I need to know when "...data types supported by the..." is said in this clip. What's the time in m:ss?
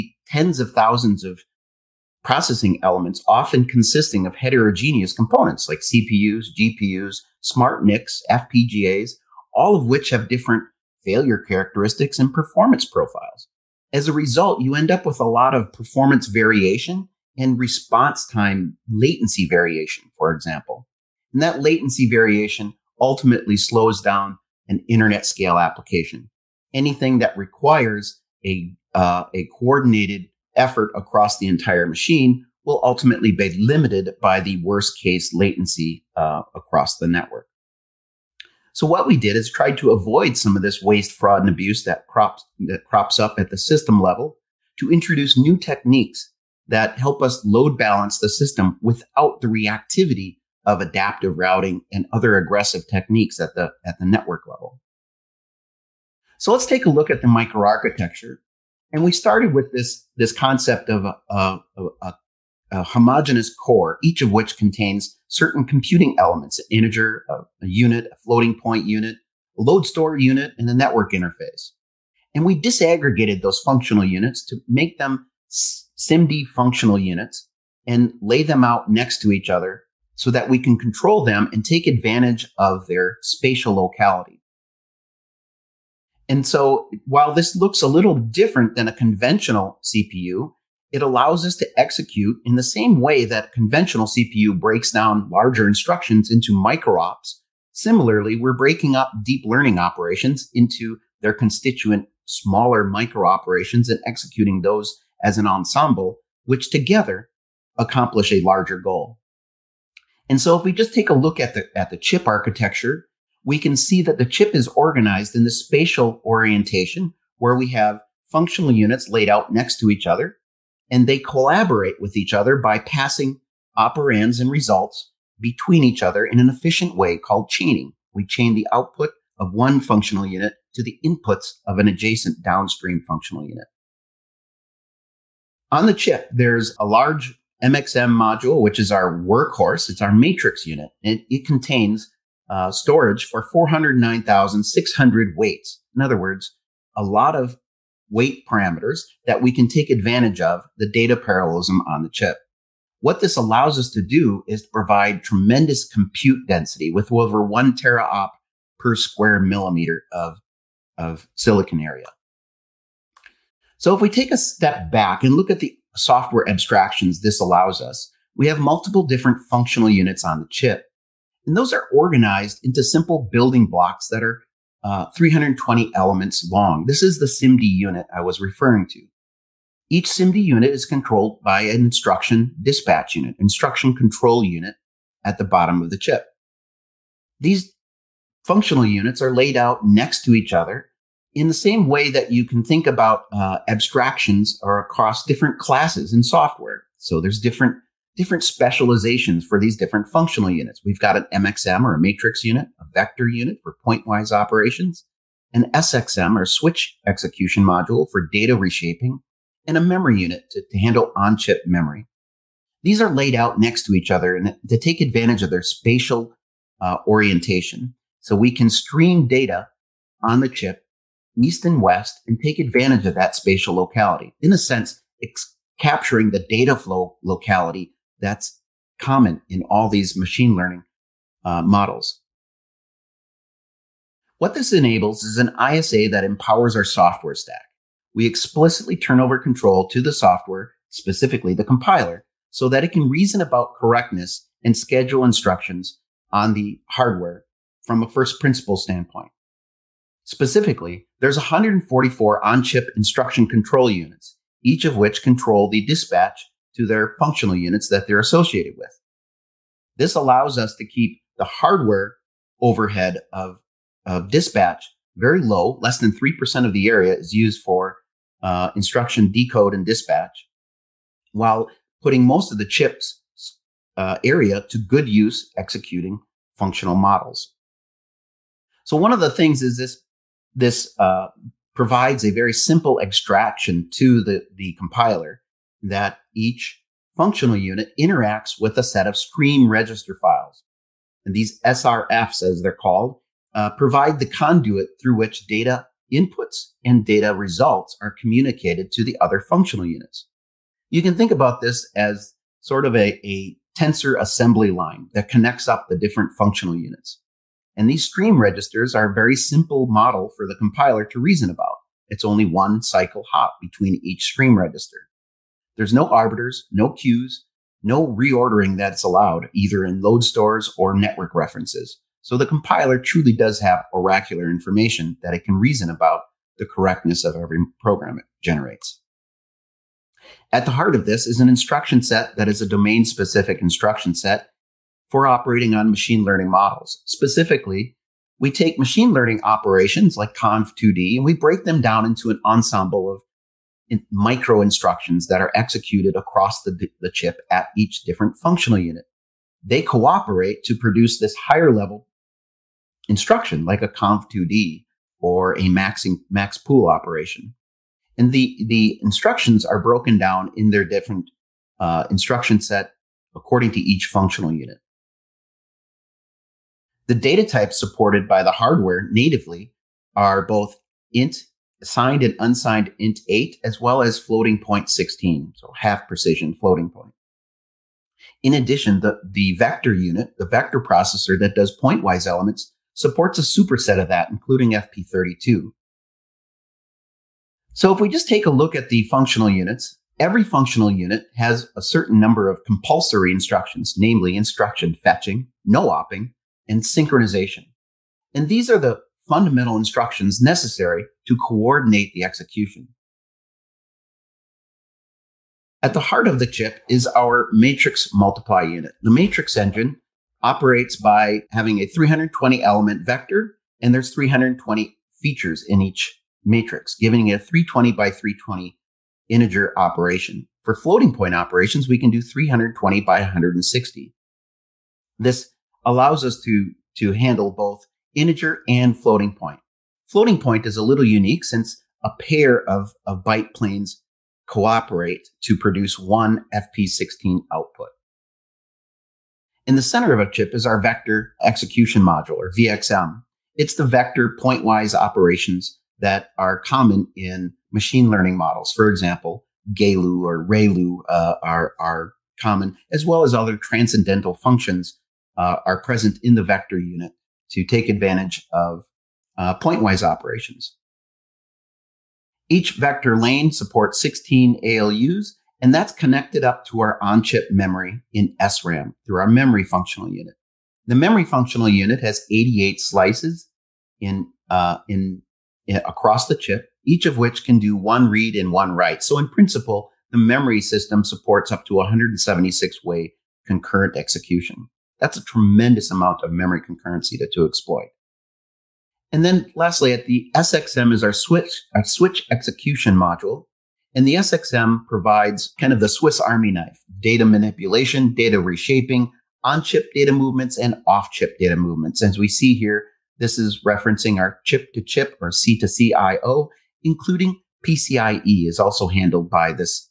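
6:07.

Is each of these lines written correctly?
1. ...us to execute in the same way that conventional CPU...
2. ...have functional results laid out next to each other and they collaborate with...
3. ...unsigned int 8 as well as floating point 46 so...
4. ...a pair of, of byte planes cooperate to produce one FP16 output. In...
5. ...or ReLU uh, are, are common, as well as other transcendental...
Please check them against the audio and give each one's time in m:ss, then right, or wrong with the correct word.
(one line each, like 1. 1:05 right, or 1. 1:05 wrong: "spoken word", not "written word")
1. 1:31 right
2. 1:57 wrong: "units", not "results"
3. 6:12 wrong: "16", not "46"
4. 7:12 right
5. 7:30 right.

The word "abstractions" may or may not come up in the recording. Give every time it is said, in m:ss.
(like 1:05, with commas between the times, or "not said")
2:46, 3:13.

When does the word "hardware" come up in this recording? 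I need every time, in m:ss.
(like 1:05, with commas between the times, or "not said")
4:06, 4:21, 6:08.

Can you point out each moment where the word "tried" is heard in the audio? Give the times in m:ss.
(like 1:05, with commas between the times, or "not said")
0:39.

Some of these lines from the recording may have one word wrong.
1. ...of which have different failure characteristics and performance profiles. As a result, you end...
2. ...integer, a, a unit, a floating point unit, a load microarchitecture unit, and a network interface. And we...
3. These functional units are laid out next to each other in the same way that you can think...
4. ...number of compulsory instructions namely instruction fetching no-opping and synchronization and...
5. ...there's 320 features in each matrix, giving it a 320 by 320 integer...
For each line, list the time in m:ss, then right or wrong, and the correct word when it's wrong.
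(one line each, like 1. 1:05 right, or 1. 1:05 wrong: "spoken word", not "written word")
1. 0:09 right
2. 1:06 wrong: "store", not "microarchitecture"
3. 3:07 right
4. 6:32 right
5. 6:53 right.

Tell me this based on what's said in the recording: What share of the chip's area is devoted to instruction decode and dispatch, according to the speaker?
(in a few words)
less than 3%.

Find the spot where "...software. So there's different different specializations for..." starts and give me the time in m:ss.
3:16.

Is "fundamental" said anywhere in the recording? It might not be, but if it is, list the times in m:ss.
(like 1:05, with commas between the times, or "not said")
6:39.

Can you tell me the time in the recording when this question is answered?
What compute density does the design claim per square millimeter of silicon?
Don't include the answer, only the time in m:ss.
2:37.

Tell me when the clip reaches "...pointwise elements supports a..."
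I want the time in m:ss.
6:21.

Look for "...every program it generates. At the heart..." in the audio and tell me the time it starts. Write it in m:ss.
5:27.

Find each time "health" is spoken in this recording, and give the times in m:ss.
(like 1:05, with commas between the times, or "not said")
not said.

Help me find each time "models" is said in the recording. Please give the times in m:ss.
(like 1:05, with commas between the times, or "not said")
3:51, 4:36, 5:09, 5:36, 7:28.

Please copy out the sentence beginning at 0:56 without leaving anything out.
So let's take a look at the microarchitecture.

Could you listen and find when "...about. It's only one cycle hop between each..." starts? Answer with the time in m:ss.
5:11.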